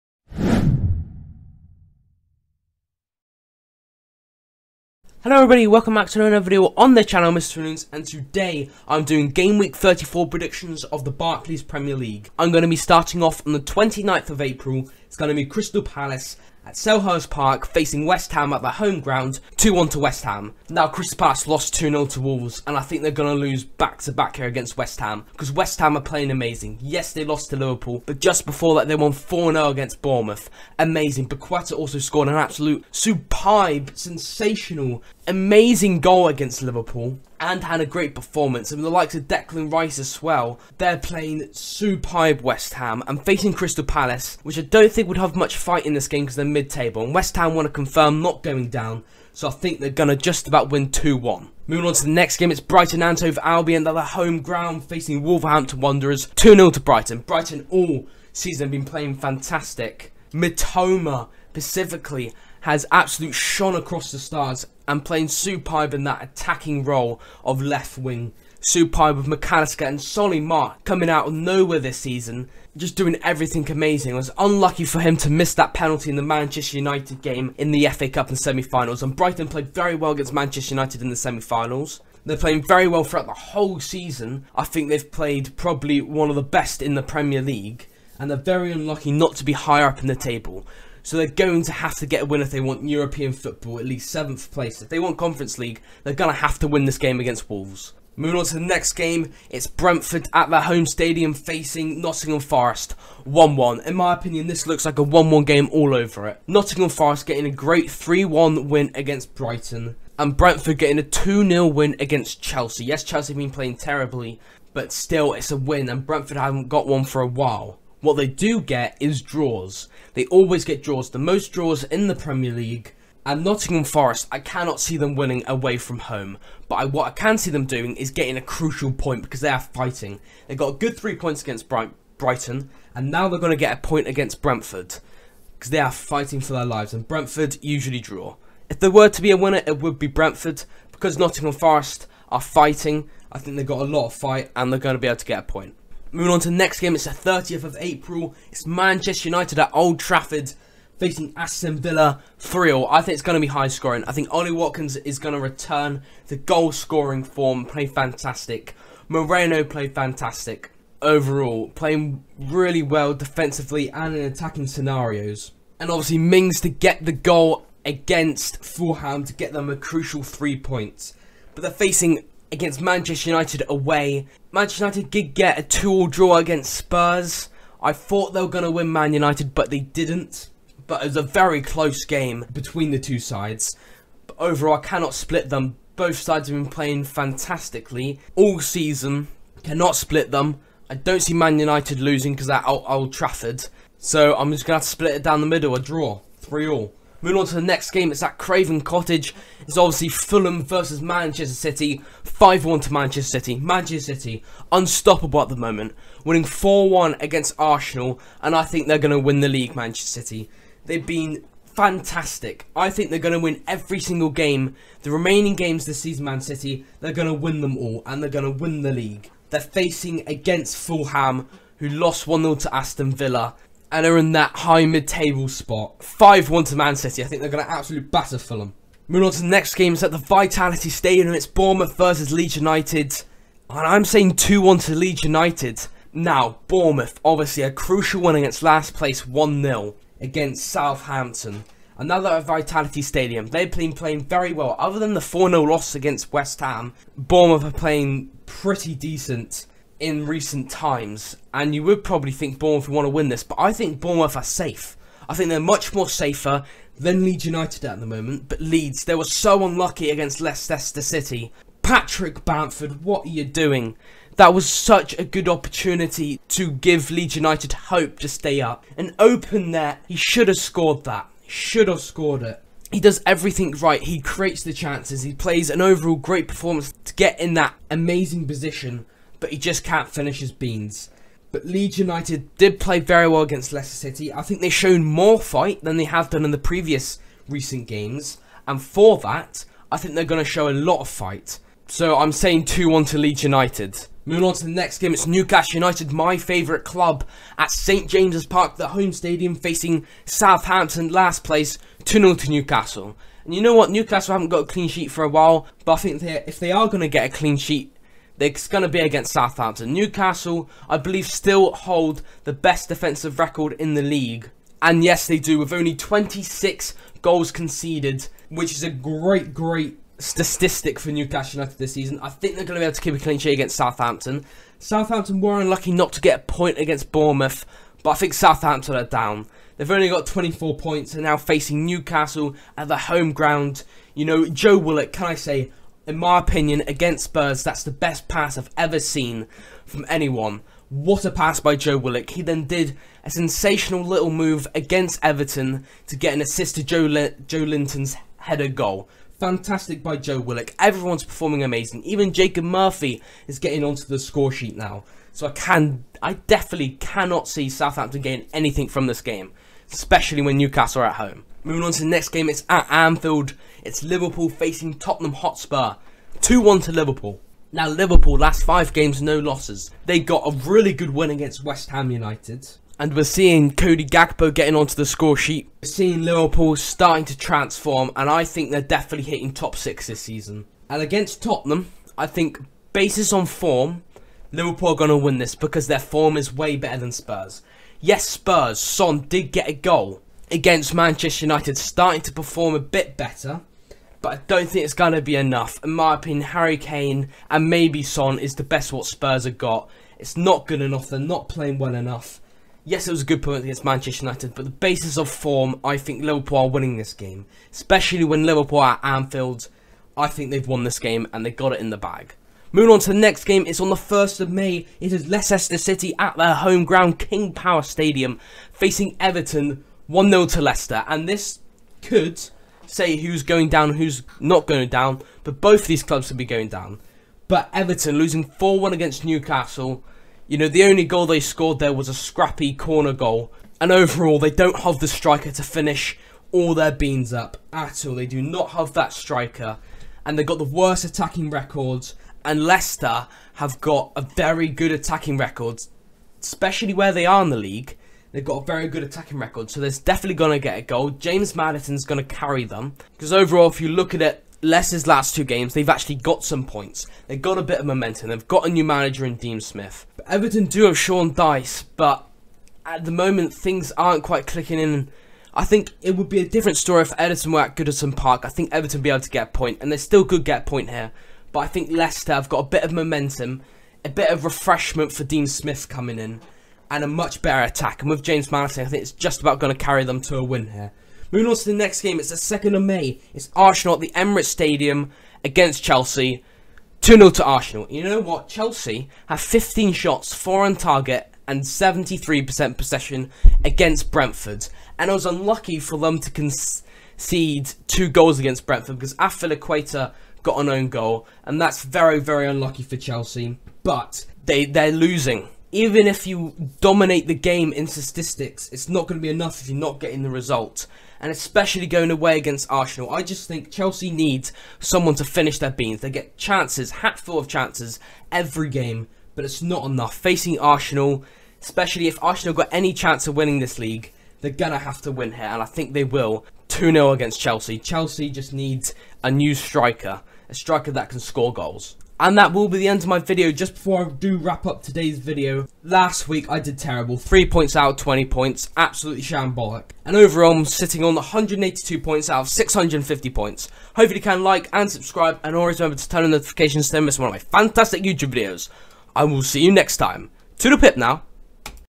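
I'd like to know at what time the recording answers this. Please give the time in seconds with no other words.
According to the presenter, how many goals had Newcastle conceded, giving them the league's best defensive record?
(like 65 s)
315 s.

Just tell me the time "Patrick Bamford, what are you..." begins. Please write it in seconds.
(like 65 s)
261 s.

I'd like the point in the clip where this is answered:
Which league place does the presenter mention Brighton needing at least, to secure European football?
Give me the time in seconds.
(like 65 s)
94 s.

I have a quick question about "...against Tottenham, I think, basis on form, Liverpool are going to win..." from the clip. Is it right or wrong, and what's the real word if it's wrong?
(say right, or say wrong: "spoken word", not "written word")
right.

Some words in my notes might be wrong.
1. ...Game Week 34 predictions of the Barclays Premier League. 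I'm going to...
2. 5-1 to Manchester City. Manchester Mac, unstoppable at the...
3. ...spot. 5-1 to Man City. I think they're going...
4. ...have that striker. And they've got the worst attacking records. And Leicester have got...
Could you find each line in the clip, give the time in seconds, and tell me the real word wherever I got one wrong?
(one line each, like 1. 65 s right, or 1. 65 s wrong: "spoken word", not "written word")
1. 9 s right
2. 202 s wrong: "City", not "Mac"
3. 225 s right
4. 438 s right.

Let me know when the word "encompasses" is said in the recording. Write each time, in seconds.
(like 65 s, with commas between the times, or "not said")
not said.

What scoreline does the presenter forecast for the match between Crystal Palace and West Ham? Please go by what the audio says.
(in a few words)
2-1 to West Ham.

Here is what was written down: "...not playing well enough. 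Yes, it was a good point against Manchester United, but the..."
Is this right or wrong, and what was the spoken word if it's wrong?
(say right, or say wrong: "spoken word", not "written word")
right.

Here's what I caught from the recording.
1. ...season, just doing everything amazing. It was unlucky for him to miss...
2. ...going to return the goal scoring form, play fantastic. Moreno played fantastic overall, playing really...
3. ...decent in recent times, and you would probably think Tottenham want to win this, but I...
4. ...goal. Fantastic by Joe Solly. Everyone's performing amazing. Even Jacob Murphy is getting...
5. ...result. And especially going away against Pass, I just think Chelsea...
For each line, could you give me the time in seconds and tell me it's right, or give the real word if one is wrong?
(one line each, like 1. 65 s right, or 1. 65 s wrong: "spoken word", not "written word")
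1. 71 s right
2. 155 s right
3. 248 s wrong: "Bournemouth", not "Tottenham"
4. 348 s wrong: "Willock", not "Solly"
5. 510 s wrong: "Arsenal", not "Pass".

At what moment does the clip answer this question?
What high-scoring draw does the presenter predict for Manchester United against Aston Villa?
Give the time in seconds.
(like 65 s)
196 s.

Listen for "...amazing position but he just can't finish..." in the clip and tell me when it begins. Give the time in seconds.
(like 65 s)
277 s.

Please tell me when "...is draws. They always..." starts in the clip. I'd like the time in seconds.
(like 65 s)
118 s.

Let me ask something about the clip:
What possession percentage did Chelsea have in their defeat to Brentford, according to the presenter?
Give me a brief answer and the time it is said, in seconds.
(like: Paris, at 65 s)
73%, at 491 s.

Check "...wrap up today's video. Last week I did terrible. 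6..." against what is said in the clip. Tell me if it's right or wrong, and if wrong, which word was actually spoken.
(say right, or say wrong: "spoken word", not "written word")
wrong: "3", not "6".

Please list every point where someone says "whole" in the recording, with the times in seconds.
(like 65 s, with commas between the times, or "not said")
83 s.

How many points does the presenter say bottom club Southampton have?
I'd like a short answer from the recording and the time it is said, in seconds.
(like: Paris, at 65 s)
24, at 330 s.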